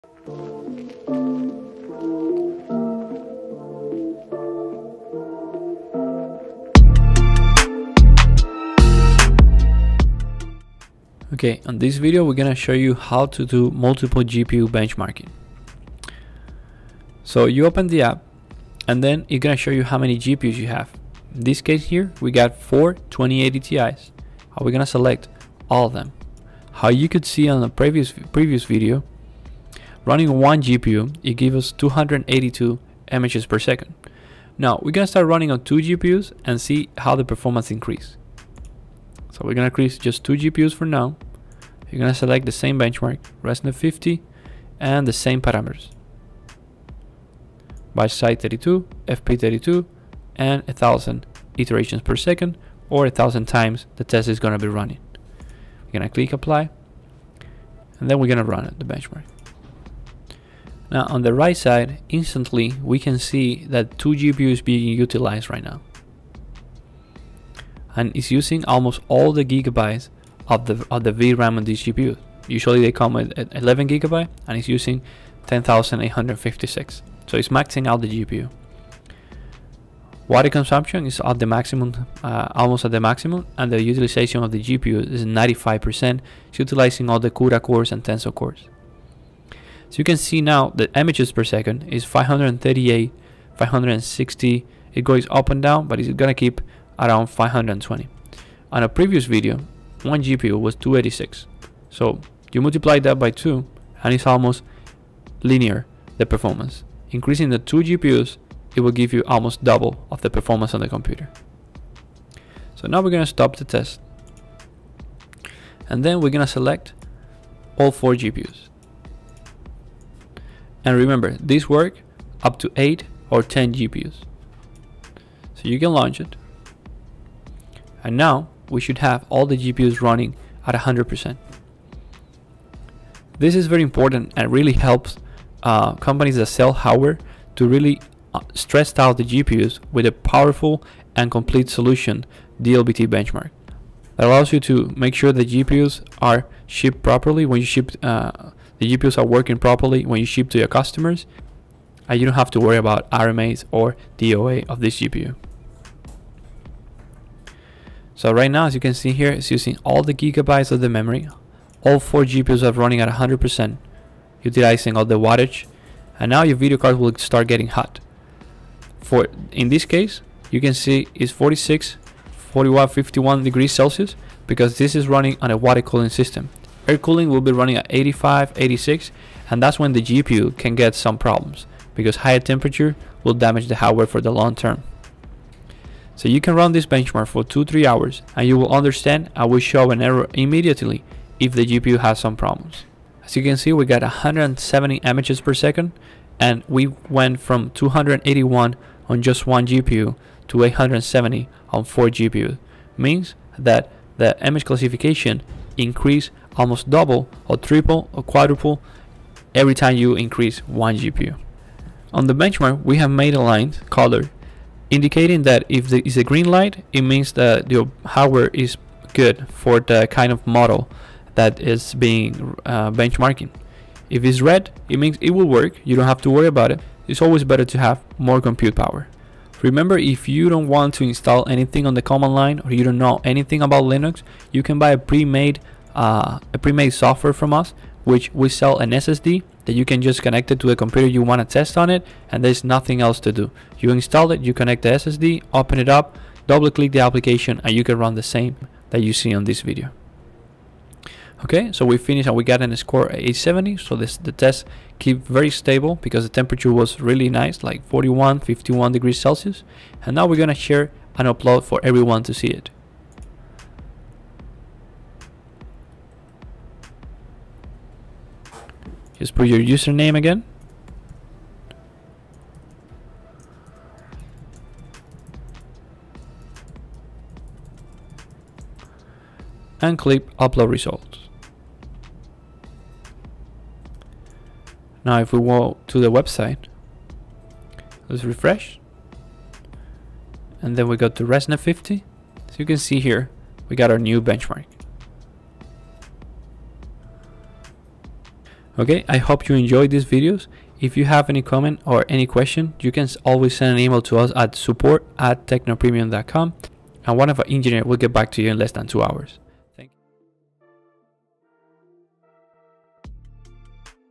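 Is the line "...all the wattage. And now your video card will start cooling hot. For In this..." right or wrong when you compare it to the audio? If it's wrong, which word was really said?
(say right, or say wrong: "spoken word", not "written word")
wrong: "getting", not "cooling".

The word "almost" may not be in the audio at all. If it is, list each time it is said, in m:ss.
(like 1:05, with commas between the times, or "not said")
1:08, 1:22, 1:44, 1:49, 3:26.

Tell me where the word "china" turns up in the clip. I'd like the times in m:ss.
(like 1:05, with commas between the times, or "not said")
not said.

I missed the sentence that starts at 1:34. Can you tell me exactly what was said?
It goes up and down, but it's gonna keep around 520.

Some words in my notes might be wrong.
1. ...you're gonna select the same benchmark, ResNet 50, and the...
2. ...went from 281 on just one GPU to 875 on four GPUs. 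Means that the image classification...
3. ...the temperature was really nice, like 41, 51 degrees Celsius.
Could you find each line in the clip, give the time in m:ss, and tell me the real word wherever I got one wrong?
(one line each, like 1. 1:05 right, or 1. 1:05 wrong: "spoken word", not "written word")
1. 0:41 right
2. 3:17 wrong: "870", not "875"
3. 4:16 right.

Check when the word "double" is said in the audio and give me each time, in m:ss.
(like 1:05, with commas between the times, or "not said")
1:49, 3:26, 4:06.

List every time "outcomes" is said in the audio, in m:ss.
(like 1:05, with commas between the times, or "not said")
not said.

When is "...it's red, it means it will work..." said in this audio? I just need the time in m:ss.
3:44.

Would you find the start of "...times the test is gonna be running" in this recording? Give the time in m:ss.
0:53.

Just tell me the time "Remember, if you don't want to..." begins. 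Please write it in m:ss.
3:49.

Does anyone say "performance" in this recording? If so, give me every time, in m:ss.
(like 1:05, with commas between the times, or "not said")
0:37, 1:46, 1:50.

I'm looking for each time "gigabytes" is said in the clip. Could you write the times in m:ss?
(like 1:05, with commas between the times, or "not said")
1:09, 1:13, 2:40.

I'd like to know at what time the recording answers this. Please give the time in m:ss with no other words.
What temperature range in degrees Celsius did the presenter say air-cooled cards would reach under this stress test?
2:57.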